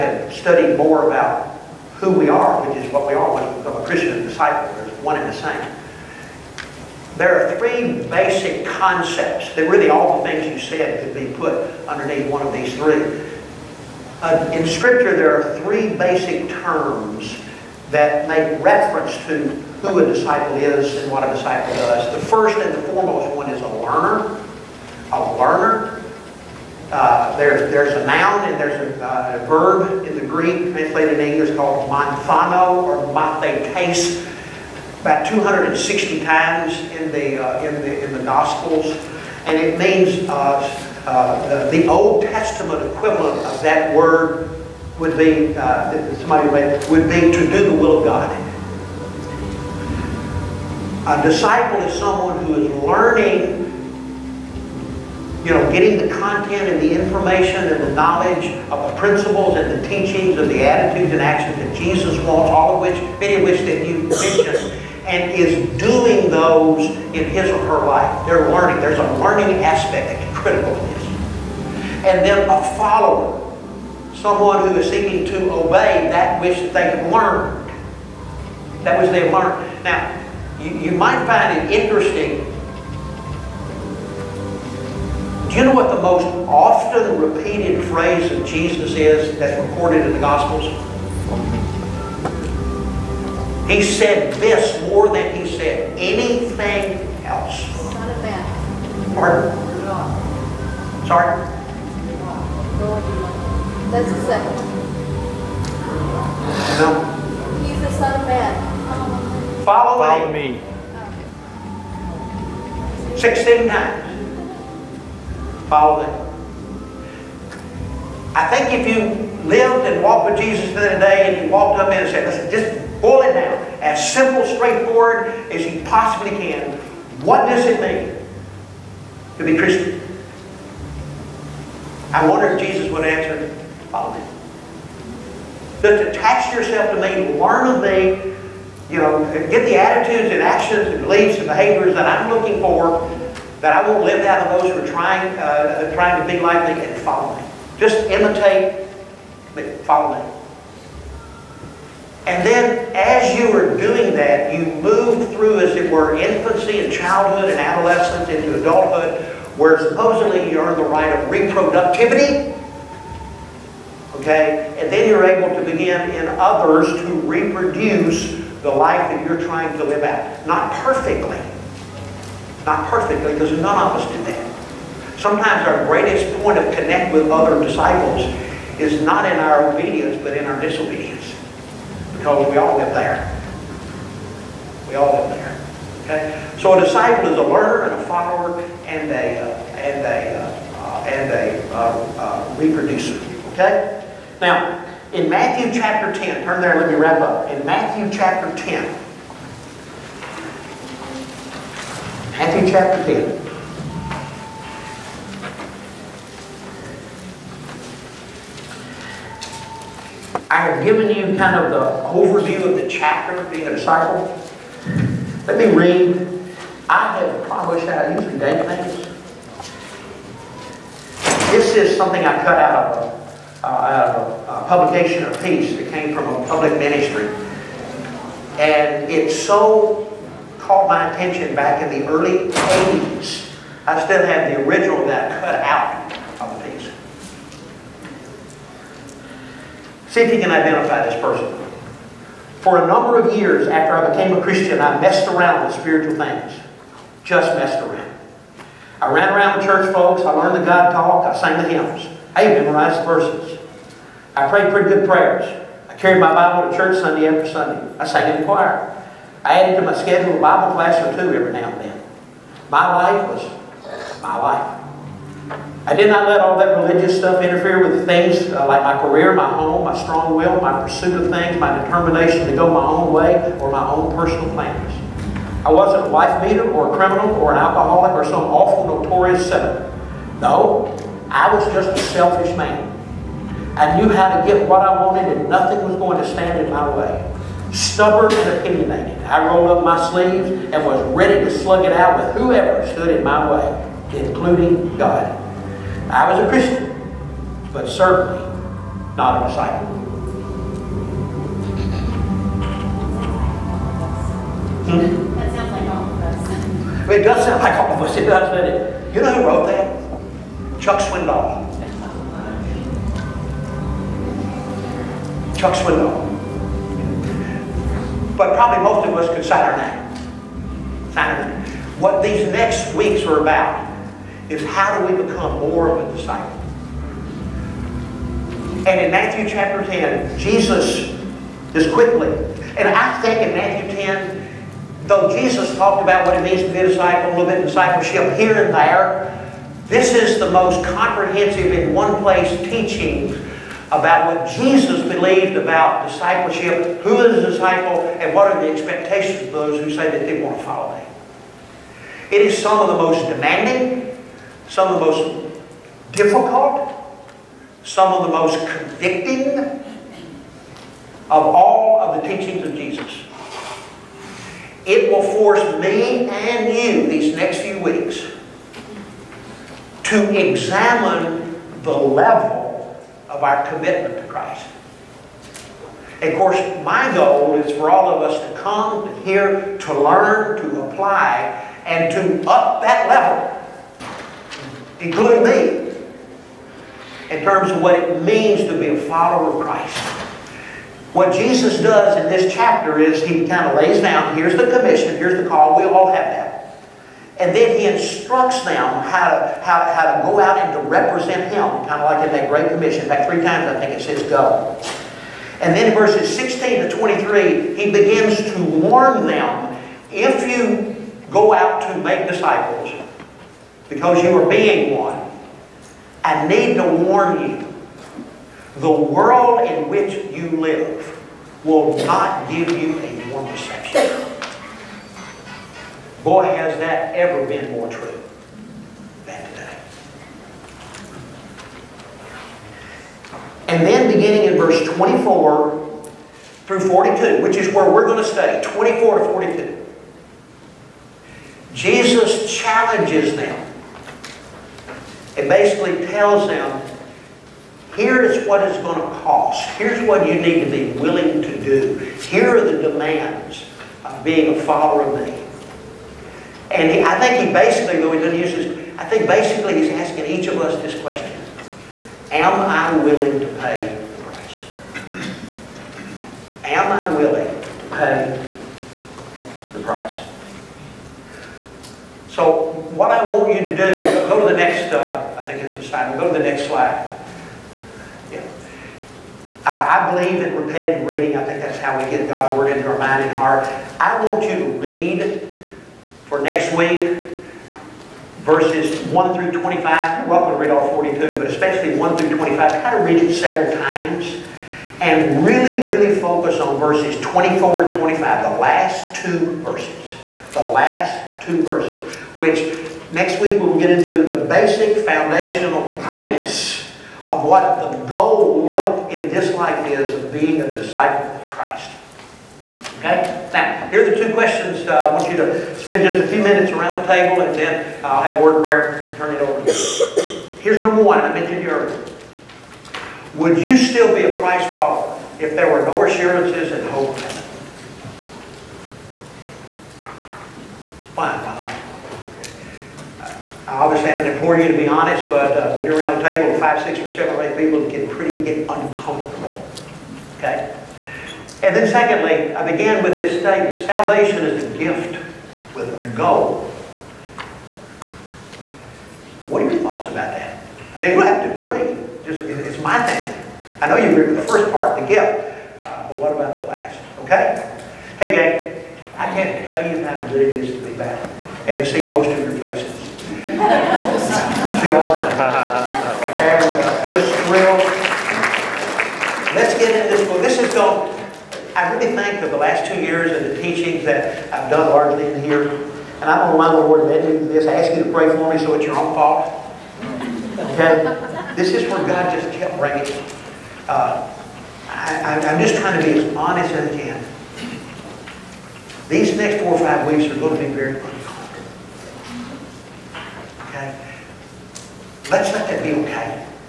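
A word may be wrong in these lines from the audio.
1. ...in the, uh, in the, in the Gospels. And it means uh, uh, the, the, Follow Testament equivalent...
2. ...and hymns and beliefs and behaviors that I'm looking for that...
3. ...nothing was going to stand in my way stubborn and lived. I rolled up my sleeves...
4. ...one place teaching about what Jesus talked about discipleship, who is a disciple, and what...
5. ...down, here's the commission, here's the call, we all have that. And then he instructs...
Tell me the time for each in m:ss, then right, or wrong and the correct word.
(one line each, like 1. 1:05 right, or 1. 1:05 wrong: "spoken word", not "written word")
1. 0:36 wrong: "Old", not "Follow"
2. 2:20 wrong: "actions", not "hymns"
3. 4:45 wrong: "opinionated", not "lived"
4. 5:41 wrong: "believed", not "talked"
5. 6:34 right.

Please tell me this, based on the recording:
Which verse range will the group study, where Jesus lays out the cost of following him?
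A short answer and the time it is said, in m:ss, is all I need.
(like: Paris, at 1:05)
24 to 42, at 7:18.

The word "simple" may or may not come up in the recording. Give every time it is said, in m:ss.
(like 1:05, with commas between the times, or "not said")
2:04.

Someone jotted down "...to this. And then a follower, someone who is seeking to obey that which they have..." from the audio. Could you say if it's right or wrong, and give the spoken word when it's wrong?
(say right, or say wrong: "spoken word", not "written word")
right.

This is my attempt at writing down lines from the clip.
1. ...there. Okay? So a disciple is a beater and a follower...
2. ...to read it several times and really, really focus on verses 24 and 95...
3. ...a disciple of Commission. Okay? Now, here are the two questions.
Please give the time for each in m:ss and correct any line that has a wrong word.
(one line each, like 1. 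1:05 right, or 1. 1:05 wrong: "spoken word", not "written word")
1. 3:05 wrong: "learner", not "beater"
2. 8:12 wrong: "25", not "95"
3. 8:30 wrong: "Christ", not "Commission".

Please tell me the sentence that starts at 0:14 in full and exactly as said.
Uh, in Scripture, there are three basic terms that make reference to who a disciple is and what a disciple does.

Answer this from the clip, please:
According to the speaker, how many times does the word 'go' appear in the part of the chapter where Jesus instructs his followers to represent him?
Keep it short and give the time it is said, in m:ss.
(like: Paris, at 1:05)
3, at 6:43.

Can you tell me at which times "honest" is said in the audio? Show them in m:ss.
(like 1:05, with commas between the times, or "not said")
8:54, 9:46.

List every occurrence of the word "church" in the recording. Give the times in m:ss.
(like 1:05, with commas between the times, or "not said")
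4:09, 4:16.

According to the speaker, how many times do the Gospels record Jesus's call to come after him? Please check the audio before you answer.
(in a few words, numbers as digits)
16.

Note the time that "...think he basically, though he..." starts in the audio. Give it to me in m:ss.
7:37.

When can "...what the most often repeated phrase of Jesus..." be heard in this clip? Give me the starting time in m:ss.
1:25.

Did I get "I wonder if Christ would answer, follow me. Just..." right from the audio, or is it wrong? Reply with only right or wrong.
wrong.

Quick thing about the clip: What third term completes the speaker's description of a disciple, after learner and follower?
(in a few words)
reproducer.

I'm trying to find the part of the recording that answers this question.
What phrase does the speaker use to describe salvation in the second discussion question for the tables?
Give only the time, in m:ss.
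9:04.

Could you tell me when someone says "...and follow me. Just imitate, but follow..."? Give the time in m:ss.
2:26.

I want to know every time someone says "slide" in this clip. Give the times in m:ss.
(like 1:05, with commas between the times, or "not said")
7:56.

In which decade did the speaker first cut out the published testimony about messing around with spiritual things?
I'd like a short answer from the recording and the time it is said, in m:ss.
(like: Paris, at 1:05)
the early 80s, at 3:52.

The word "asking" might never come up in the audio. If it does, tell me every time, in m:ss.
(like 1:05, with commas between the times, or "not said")
7:39.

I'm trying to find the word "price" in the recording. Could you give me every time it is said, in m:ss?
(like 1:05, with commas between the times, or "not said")
7:44, 7:49.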